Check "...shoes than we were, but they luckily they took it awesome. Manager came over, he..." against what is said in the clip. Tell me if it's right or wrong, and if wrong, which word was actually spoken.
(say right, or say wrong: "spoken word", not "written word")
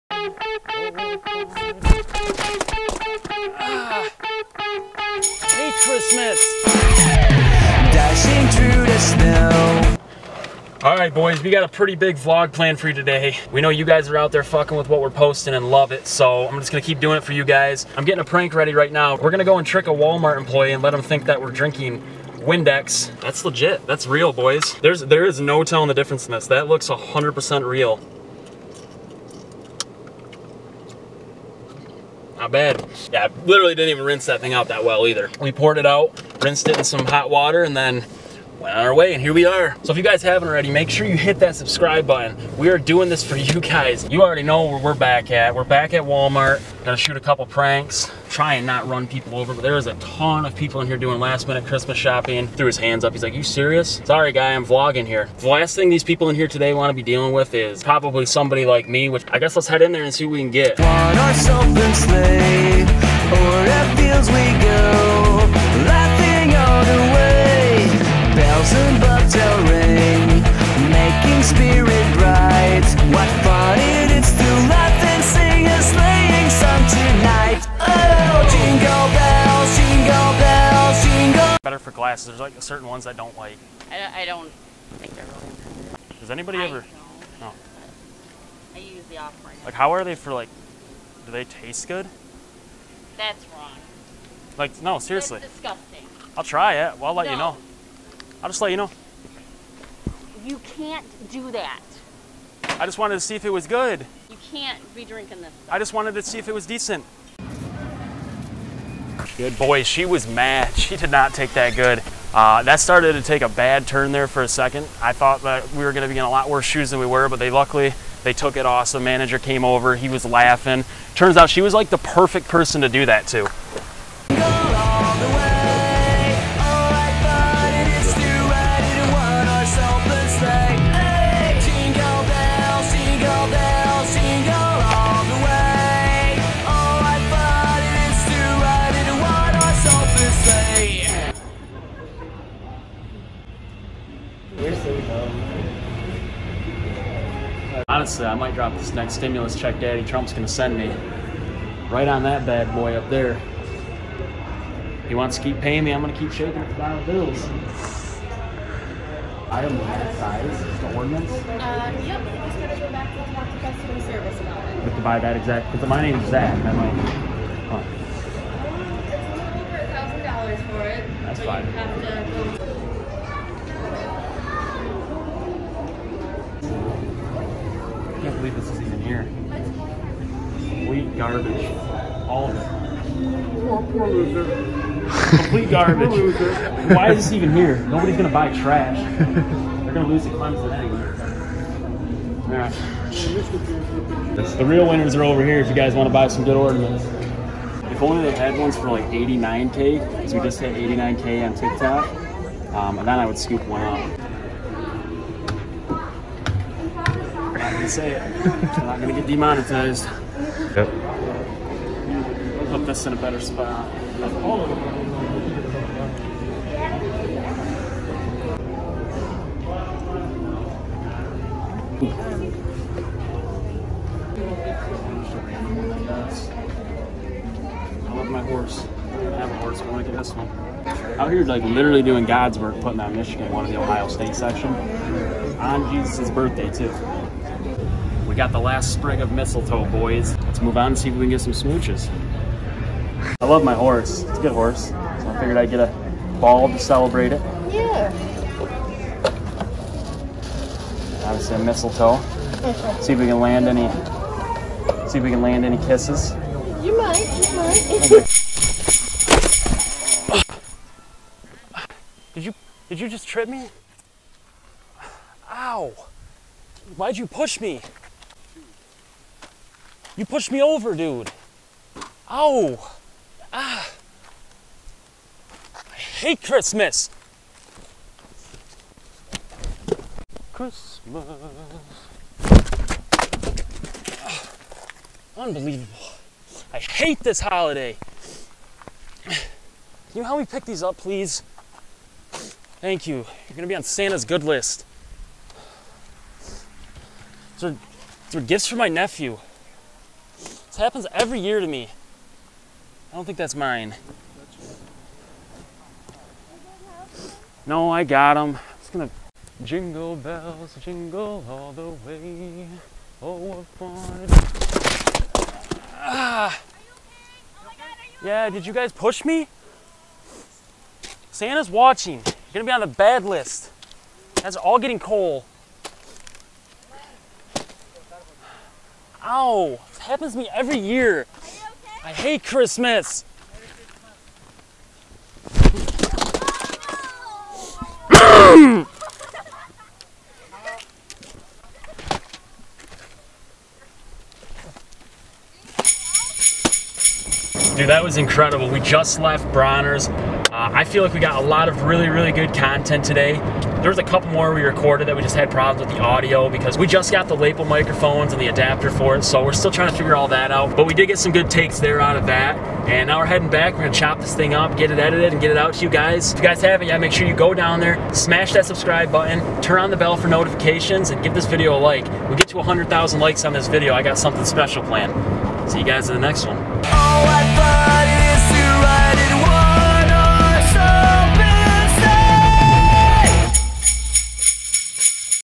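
right.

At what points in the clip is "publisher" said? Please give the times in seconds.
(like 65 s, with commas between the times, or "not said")
not said.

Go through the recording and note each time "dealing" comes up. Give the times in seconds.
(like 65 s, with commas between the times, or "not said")
57 s.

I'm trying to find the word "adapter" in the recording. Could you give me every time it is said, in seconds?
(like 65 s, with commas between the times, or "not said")
358 s.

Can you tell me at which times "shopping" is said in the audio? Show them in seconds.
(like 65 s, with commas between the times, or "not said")
51 s.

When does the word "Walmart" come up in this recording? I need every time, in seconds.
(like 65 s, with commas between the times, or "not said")
19 s, 46 s.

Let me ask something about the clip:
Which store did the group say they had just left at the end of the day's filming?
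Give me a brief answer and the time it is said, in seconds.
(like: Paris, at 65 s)
Bronner's, at 349 s.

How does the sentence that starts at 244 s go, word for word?
So I figured I'd get a ball to celebrate it.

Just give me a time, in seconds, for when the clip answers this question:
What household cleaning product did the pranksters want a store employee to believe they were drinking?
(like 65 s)
22 s.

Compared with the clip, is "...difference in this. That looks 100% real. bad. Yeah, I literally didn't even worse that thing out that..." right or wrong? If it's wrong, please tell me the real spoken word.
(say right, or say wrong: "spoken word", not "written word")
wrong: "rinse", not "worse".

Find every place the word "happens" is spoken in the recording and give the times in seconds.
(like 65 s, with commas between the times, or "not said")
300 s, 330 s.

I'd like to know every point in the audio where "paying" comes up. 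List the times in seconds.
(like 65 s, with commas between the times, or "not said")
155 s.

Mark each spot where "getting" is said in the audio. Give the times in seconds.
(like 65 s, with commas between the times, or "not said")
18 s, 324 s.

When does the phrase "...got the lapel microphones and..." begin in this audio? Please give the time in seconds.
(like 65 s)
357 s.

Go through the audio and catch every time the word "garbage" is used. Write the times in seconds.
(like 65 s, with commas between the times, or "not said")
181 s, 185 s.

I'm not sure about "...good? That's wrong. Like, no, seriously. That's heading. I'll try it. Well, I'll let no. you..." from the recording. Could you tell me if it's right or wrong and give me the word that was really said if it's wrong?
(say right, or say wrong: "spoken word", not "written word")
wrong: "disgusting", not "heading".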